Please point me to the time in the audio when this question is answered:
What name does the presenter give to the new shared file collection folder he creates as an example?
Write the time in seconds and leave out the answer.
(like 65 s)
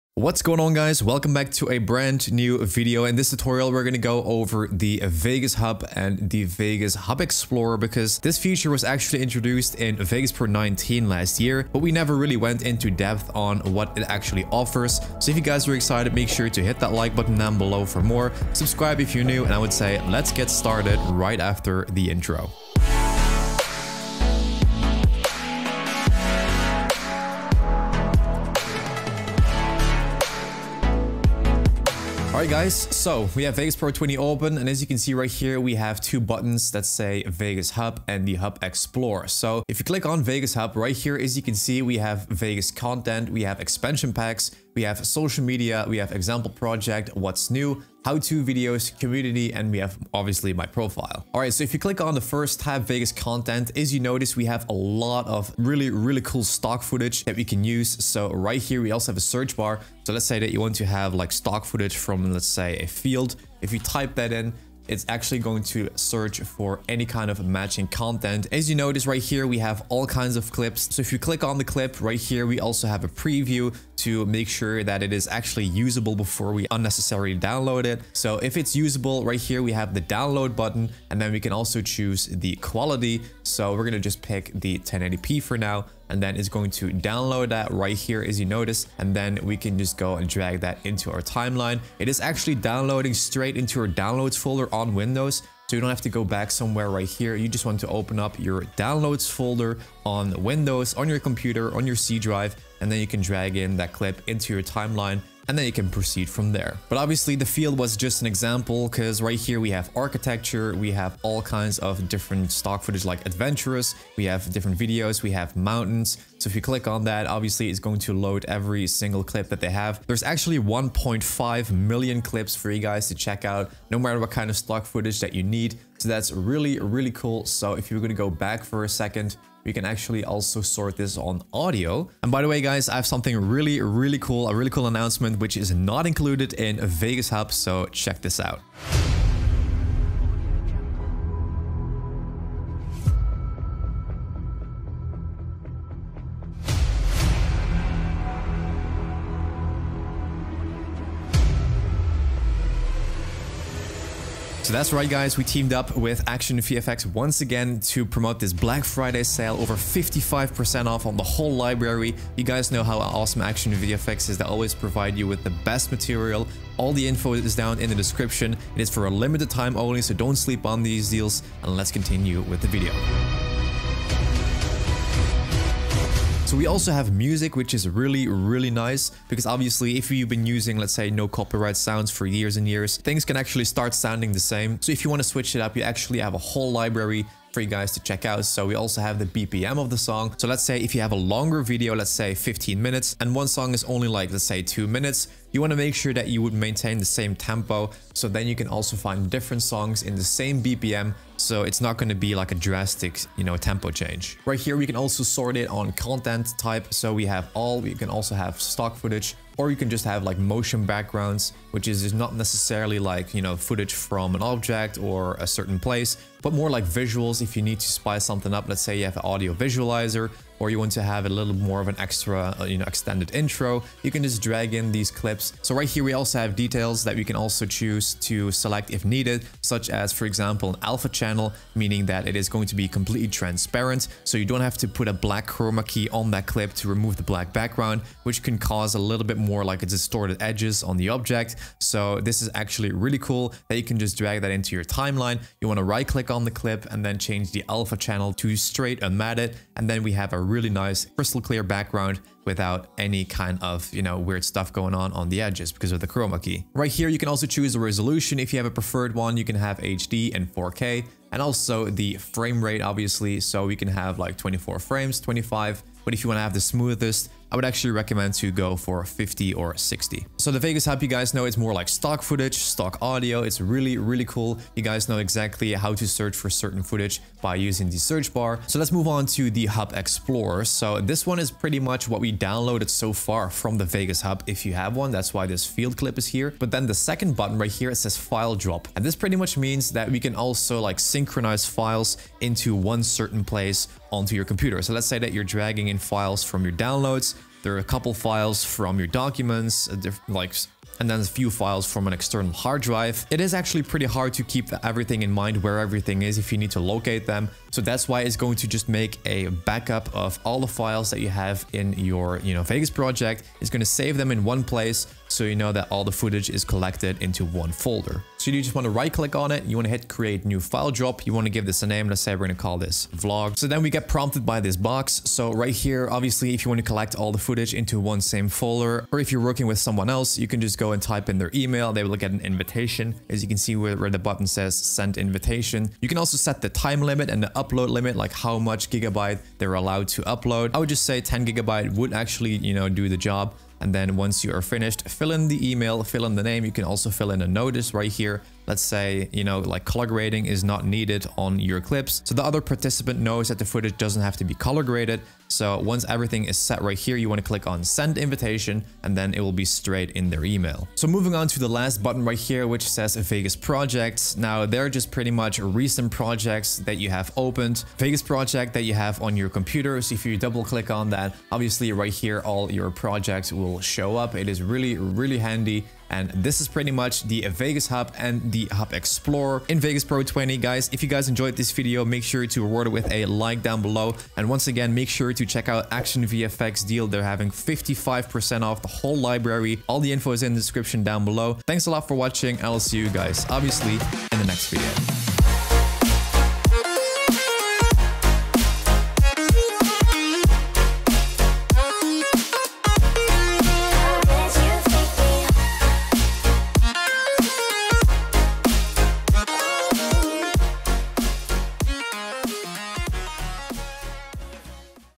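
323 s.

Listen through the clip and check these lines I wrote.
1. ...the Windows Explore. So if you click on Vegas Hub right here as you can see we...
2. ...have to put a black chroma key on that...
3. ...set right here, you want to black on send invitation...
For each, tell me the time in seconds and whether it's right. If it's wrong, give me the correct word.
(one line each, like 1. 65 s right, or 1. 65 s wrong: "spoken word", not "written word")
1. 38 s wrong: "Hub", not "Windows"
2. 234 s right
3. 356 s wrong: "click", not "black".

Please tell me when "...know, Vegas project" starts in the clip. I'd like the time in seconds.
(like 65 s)
312 s.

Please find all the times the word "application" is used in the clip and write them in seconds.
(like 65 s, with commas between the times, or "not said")
not said.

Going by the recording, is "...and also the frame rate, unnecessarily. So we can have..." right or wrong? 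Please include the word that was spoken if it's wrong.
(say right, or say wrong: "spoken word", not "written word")
wrong: "obviously", not "unnecessarily".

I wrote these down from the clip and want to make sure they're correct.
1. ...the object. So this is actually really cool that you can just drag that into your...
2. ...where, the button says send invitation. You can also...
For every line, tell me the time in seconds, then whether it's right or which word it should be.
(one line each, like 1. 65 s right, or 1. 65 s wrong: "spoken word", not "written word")
1. 240 s right
2. 333 s right.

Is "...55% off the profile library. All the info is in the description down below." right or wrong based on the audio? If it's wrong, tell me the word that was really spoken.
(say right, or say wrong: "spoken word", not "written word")
wrong: "whole", not "profile".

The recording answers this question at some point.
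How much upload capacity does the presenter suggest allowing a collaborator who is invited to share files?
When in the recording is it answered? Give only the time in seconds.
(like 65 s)
341 s.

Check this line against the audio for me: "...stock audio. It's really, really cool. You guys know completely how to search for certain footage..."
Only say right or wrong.
wrong.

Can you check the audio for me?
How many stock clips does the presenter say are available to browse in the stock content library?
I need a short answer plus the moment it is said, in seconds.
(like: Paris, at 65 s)
1.5 million, at 120 s.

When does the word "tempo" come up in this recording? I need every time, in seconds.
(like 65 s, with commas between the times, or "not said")
197 s, 203 s.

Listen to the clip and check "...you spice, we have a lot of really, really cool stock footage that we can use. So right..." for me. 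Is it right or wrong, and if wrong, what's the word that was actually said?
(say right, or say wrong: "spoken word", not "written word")
wrong: "notice", not "spice".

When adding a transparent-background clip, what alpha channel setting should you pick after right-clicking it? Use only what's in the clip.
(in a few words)
straight unmatted.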